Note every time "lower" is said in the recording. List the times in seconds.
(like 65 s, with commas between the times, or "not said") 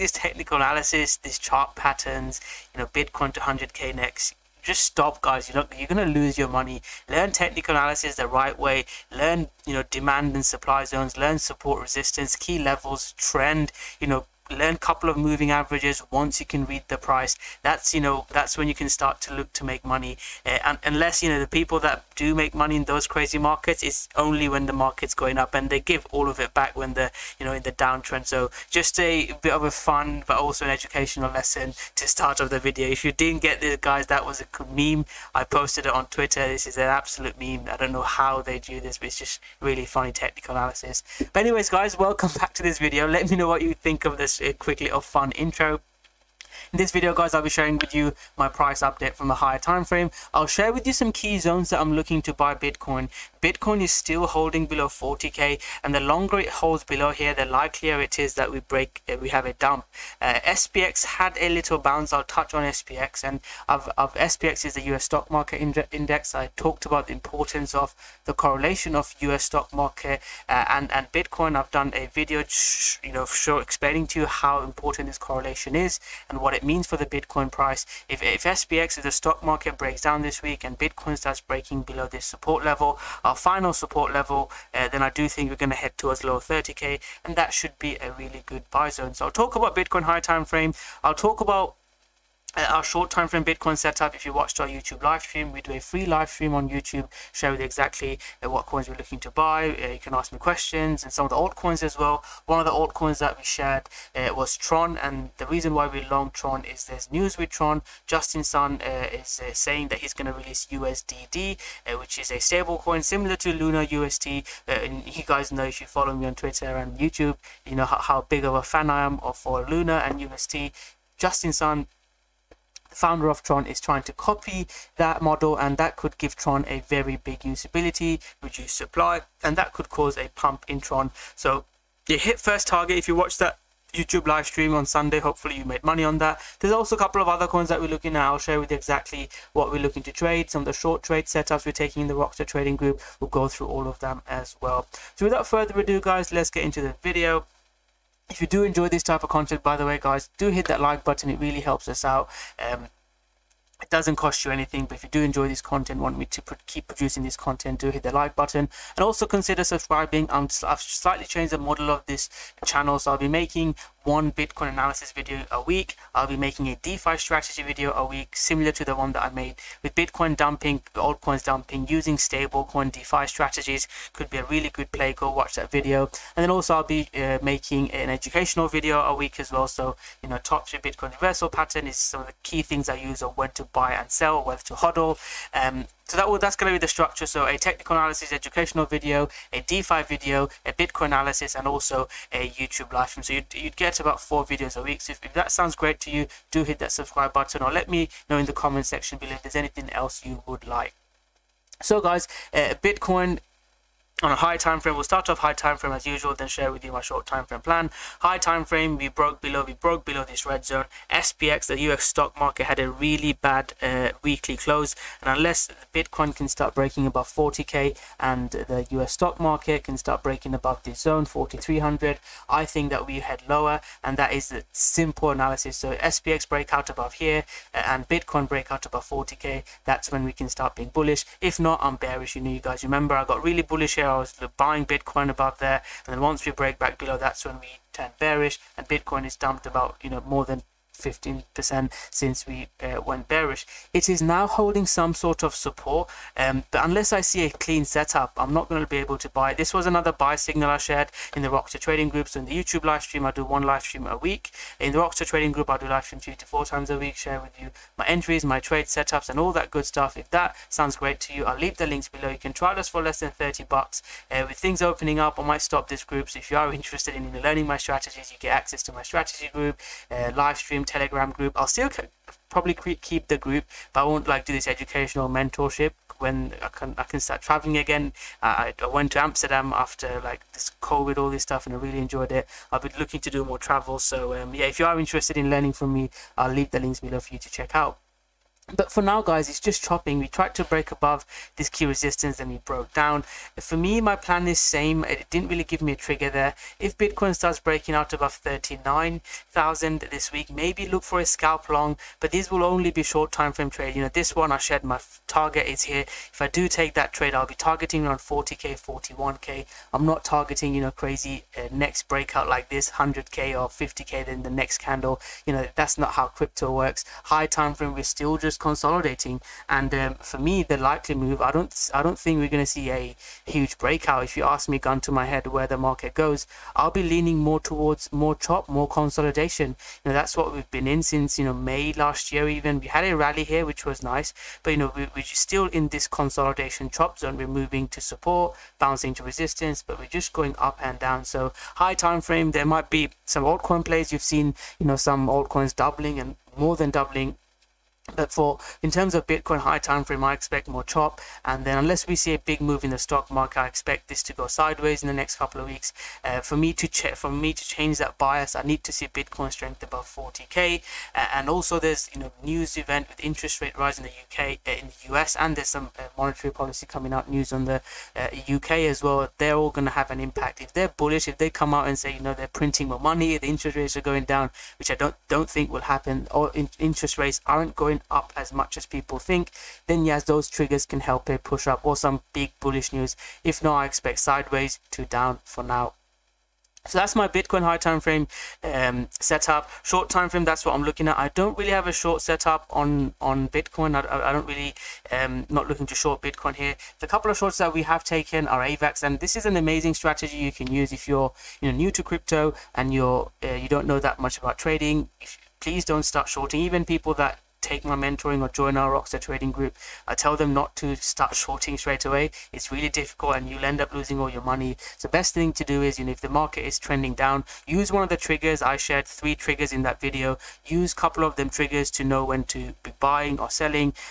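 86 s, 223 s.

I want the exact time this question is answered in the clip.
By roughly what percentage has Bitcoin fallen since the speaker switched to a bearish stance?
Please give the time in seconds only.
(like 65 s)
240 s.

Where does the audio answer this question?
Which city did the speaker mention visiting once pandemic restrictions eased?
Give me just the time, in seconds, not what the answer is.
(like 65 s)
279 s.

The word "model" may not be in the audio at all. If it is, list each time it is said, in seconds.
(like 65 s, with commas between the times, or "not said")
125 s, 161 s.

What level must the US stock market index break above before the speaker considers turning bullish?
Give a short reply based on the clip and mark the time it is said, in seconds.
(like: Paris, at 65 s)
4300, at 221 s.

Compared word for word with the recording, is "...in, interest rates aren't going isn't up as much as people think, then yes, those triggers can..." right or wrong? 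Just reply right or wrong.
right.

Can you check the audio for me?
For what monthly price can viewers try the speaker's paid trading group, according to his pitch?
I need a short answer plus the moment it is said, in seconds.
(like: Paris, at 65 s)
less than 30 bucks, at 263 s.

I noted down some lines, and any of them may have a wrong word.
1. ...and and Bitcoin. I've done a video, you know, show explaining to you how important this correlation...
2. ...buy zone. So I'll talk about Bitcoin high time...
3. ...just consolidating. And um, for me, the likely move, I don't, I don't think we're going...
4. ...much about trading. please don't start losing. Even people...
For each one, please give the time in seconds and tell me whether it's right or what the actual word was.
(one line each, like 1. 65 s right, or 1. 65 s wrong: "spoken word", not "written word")
1. 70 s right
2. 88 s right
3. 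318 s right
4. 404 s wrong: "shorting", not "losing".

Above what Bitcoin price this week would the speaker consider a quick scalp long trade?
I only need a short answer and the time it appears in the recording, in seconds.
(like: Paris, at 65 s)
39,000, at 298 s.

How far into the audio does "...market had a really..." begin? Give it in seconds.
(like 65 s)
212 s.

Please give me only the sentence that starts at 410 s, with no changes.
I tell them not to start shorting straight away.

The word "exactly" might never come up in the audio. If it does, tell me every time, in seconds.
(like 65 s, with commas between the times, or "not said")
97 s, 138 s.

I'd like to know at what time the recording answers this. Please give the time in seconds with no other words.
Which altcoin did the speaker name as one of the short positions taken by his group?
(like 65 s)
398 s.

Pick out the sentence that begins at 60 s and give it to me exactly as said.
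Uh, SPX had a little bounce.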